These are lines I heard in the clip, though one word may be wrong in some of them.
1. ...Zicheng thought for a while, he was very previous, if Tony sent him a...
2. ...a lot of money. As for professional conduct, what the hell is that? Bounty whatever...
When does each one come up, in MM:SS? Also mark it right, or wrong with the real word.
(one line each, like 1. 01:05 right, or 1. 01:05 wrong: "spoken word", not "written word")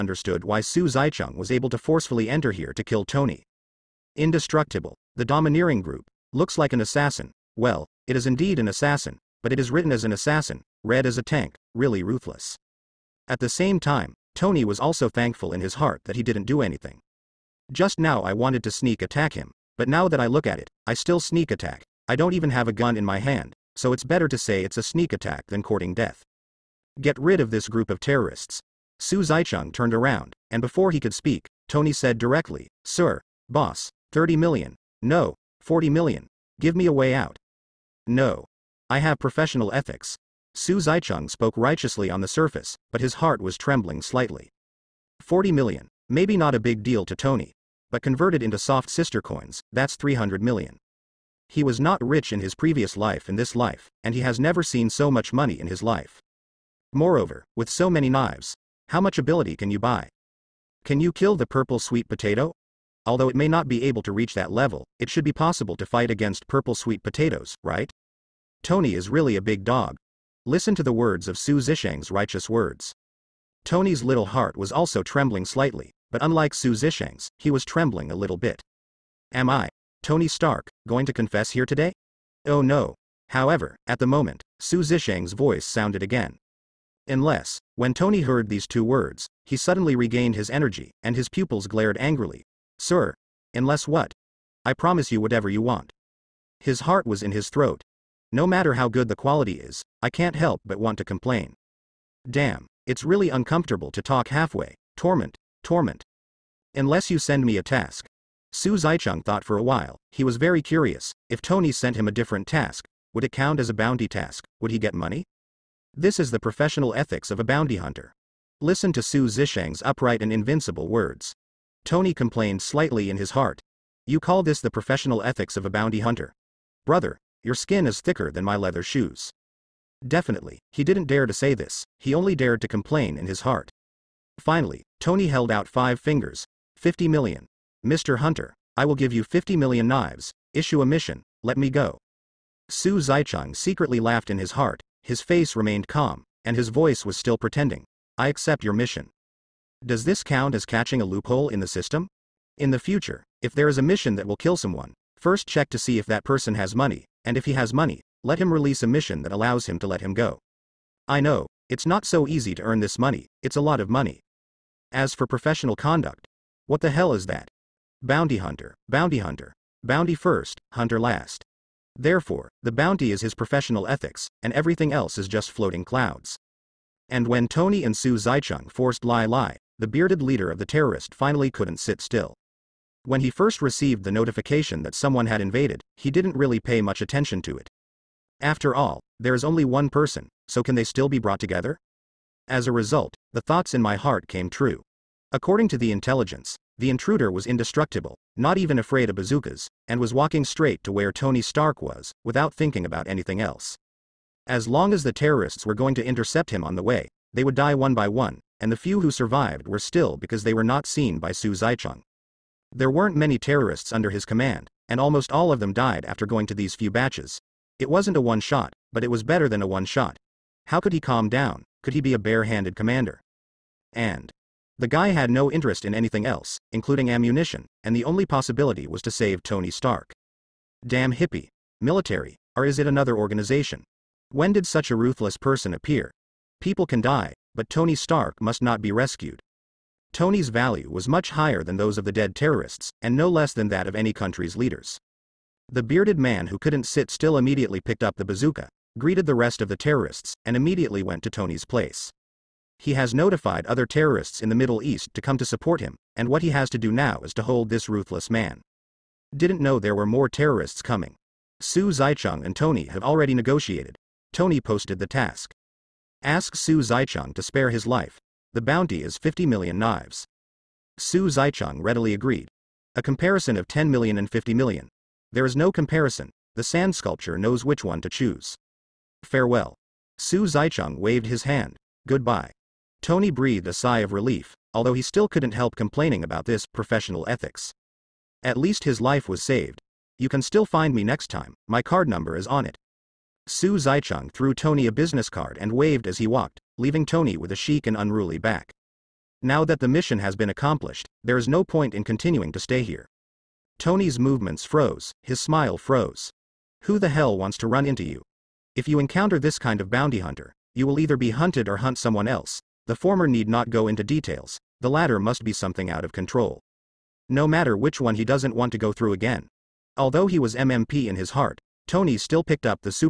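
1. 01:48 wrong: "curious", not "previous"
2. 02:43 wrong: "hunter", not "whatever".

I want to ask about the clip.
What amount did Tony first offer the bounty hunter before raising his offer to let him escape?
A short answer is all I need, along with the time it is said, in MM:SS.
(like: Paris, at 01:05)
30 million, at 00:34.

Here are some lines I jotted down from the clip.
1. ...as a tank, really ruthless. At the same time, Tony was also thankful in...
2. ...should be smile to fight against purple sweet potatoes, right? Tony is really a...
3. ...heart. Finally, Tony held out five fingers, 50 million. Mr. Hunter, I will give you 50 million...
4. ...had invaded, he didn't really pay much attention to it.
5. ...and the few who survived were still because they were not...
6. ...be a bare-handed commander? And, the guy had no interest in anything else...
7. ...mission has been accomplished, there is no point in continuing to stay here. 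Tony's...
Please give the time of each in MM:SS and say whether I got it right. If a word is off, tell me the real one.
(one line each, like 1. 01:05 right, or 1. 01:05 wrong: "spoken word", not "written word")
1. 00:11 right
2. 01:05 wrong: "possible", not "smile"
3. 02:13 right
4. 03:05 right
5. 03:28 right
6. 03:41 right
7. 04:59 right.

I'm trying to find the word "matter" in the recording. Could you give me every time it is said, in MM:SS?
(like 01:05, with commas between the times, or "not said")
01:38, 05:17.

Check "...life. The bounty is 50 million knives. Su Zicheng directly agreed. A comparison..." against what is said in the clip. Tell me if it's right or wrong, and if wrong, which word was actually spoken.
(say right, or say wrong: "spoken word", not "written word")
wrong: "readily", not "directly".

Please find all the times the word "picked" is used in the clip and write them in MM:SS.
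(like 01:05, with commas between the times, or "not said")
04:07, 05:22.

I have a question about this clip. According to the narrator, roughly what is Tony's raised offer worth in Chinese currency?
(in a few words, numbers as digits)
300 million.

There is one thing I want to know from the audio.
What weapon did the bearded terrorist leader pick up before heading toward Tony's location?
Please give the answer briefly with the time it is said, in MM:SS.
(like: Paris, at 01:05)
bazooka, at 04:08.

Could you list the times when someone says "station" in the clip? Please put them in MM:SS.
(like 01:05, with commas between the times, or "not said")
not said.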